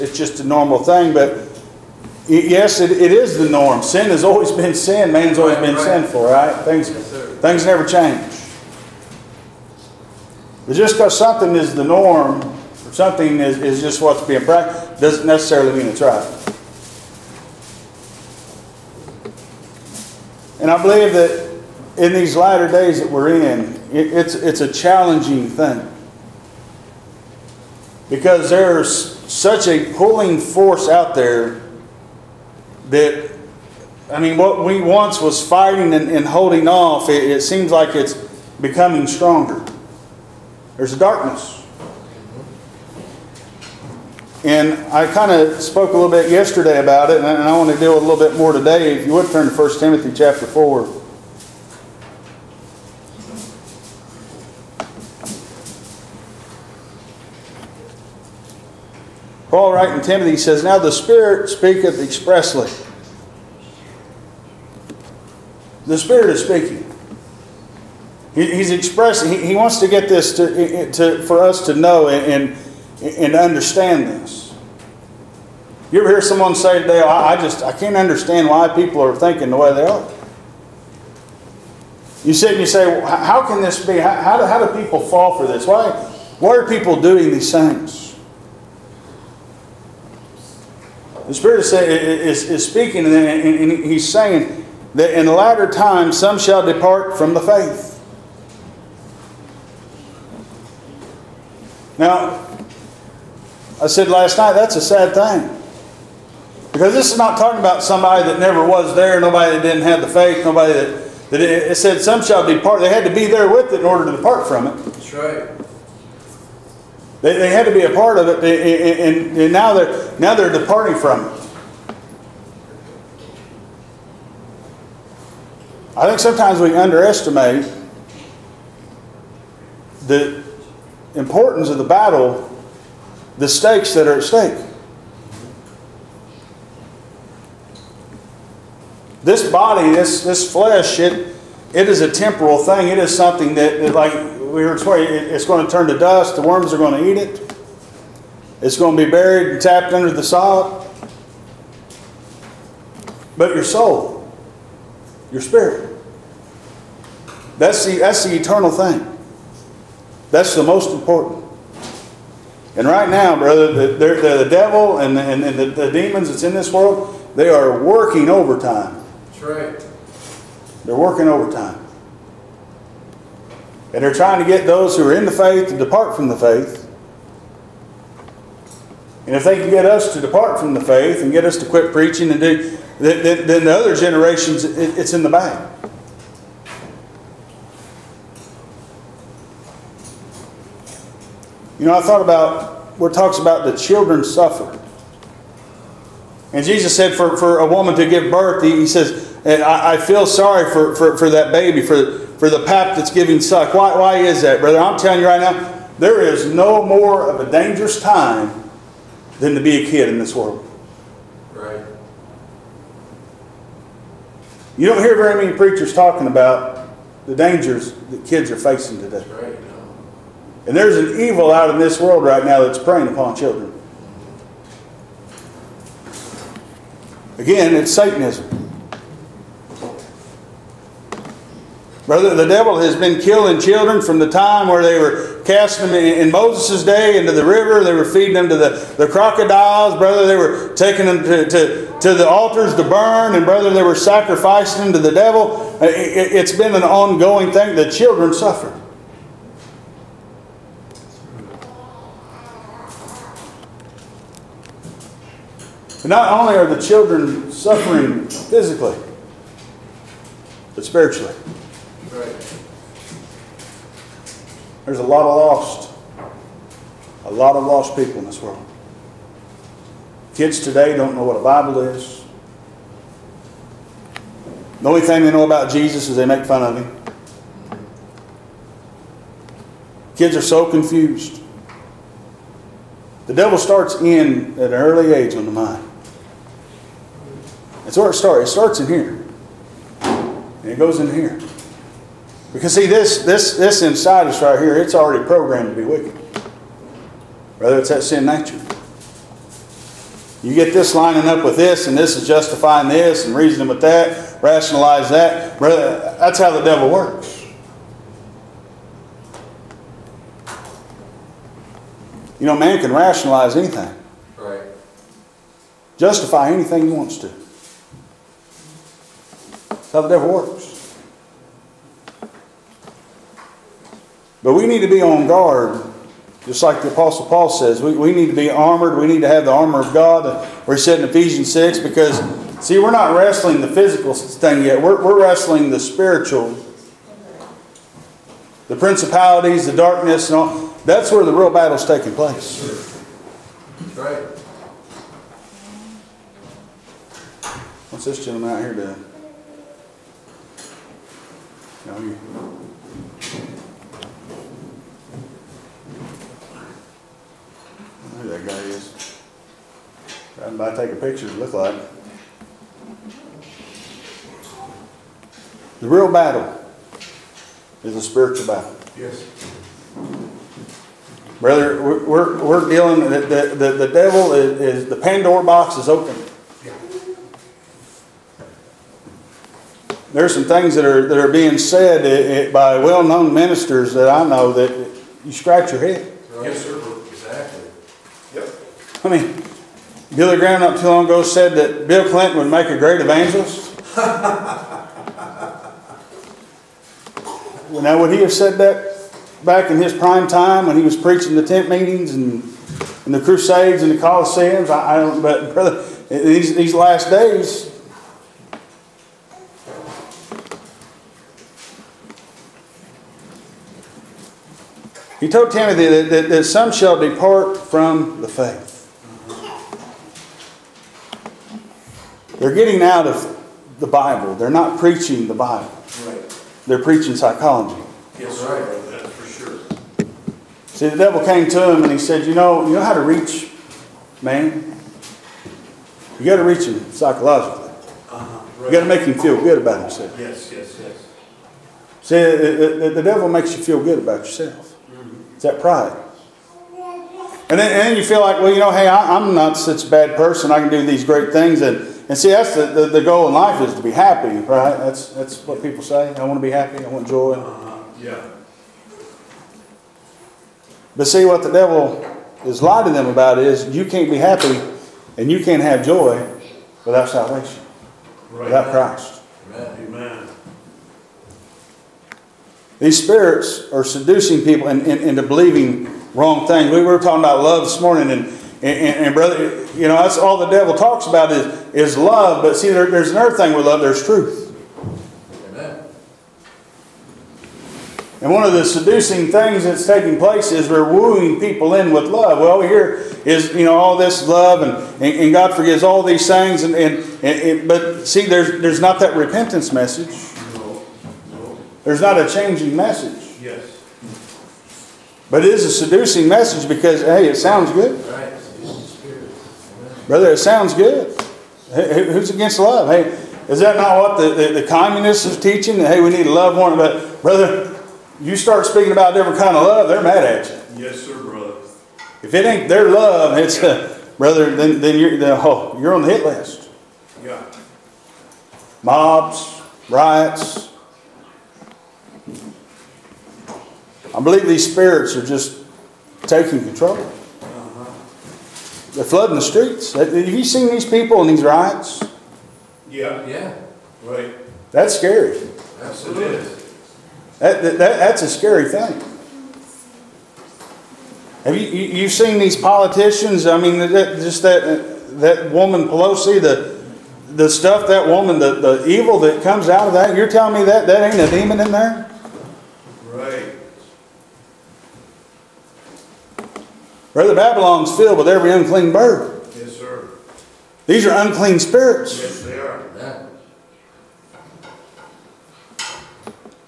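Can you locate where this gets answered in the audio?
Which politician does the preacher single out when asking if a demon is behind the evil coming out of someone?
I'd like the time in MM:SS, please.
09:15.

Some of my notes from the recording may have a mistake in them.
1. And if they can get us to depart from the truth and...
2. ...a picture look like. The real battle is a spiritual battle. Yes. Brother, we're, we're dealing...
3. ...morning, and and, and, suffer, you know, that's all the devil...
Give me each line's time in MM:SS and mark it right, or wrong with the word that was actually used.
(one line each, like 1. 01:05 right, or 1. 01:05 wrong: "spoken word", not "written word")
1. 02:59 wrong: "faith", not "truth"
2. 06:00 right
3. 07:57 wrong: "brother", not "suffer".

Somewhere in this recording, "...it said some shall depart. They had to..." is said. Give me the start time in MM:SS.
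01:51.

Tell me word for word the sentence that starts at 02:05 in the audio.
I think sometimes we underestimate the importance of the battle, the stakes that are at stake.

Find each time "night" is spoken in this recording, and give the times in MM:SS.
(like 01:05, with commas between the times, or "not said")
01:44.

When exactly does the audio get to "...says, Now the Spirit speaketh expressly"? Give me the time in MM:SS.
01:00.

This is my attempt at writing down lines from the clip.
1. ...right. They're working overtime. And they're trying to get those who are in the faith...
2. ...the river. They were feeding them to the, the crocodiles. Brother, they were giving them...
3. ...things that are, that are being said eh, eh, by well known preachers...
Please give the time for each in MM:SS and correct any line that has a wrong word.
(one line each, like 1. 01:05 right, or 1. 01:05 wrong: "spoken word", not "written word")
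1. 02:49 right
2. 03:57 wrong: "taking", not "giving"
3. 06:20 wrong: "ministers", not "preachers".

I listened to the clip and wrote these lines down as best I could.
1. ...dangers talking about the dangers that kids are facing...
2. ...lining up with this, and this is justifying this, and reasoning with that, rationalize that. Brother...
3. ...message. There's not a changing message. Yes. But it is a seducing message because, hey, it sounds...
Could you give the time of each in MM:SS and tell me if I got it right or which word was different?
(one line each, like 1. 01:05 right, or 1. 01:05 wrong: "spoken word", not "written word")
1. 03:35 wrong: "preachers", not "dangers"
2. 05:00 right
3. 08:19 right.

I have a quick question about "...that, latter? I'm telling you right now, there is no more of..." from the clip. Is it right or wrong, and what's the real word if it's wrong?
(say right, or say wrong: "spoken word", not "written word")
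wrong: "brother", not "latter".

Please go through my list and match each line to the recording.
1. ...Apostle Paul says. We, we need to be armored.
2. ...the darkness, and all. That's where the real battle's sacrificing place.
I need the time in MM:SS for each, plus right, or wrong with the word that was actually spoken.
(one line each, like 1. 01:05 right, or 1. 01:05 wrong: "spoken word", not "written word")
1. 05:26 right
2. 05:39 wrong: "taking", not "sacrificing".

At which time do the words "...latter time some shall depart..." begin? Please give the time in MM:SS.
01:35.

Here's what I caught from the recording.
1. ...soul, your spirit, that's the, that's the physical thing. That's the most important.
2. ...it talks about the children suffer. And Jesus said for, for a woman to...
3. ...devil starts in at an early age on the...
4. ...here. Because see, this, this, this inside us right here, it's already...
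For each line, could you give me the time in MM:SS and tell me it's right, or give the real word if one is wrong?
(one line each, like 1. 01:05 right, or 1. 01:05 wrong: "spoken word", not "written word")
1. 02:33 wrong: "eternal", not "physical"
2. 03:13 right
3. 04:43 right
4. 04:51 right.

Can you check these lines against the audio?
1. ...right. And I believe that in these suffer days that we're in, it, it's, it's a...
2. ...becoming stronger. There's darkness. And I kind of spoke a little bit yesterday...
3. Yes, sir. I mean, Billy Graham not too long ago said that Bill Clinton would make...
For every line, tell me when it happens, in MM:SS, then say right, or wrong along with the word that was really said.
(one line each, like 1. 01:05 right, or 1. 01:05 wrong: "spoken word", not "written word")
1. 00:16 wrong: "latter", not "suffer"
2. 00:38 right
3. 06:26 right.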